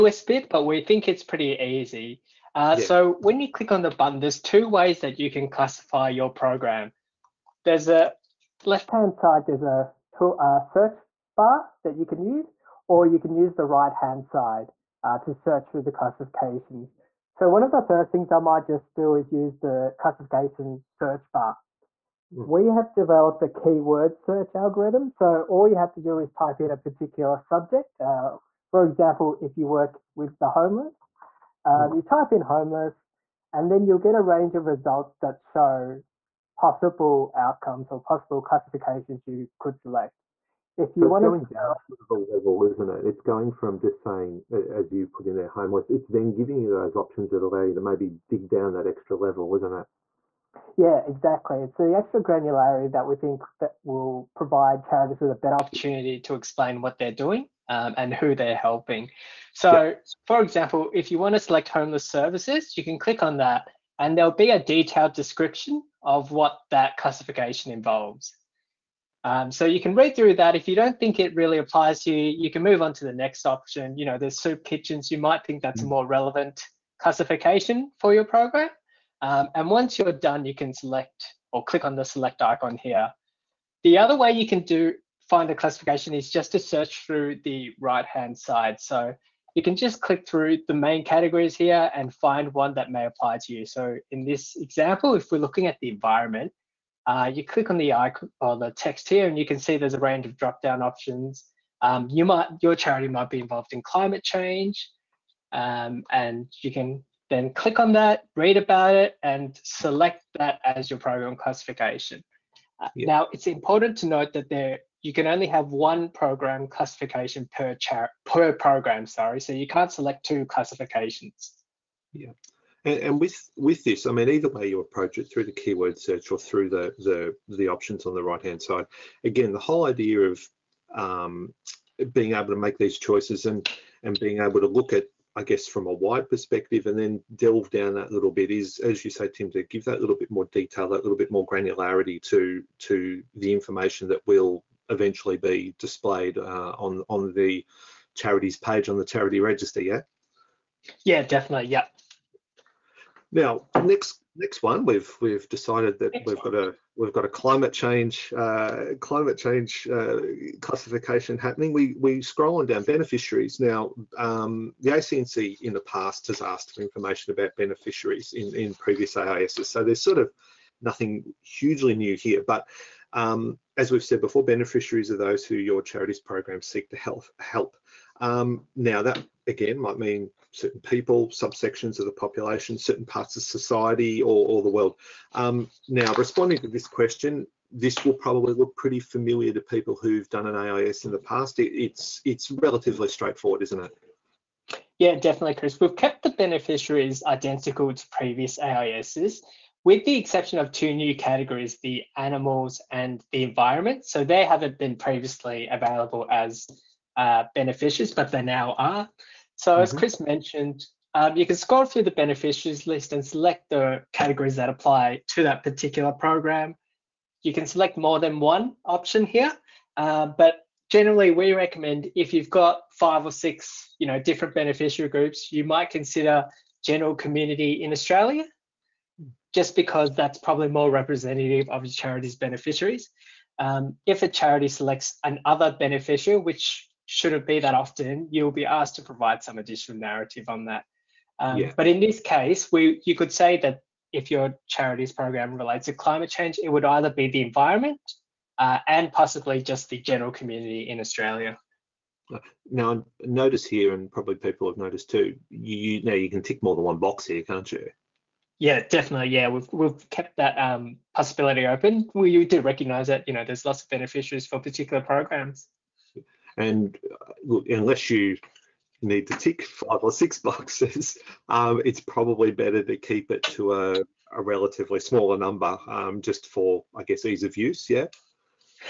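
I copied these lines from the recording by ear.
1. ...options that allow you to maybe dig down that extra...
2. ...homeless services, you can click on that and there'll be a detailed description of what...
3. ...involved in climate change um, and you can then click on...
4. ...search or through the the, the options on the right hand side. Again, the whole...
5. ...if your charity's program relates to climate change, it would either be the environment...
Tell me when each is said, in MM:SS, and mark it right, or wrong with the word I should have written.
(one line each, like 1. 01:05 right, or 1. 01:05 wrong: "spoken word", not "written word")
1. 00:46 right
2. 01:01 right
3. 01:43 right
4. 02:05 right
5. 04:04 right.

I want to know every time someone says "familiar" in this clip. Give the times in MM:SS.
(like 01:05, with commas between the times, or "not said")
03:09.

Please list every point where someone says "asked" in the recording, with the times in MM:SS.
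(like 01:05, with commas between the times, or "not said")
02:46, 03:58.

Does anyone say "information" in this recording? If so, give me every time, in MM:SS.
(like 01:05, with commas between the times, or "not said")
02:23, 02:46.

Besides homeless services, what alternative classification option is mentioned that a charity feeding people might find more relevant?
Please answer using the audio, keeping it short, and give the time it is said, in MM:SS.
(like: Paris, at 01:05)
soup kitchens, at 01:14.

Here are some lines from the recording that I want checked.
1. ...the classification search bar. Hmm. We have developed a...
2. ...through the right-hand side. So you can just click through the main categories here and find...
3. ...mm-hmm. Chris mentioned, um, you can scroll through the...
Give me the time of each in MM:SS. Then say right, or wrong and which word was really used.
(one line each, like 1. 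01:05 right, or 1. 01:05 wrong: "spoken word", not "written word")
1. 00:19 right
2. 01:27 right
3. 03:29 right.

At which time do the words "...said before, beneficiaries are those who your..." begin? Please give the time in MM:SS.
02:54.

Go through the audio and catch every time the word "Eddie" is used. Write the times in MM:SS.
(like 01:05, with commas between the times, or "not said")
not said.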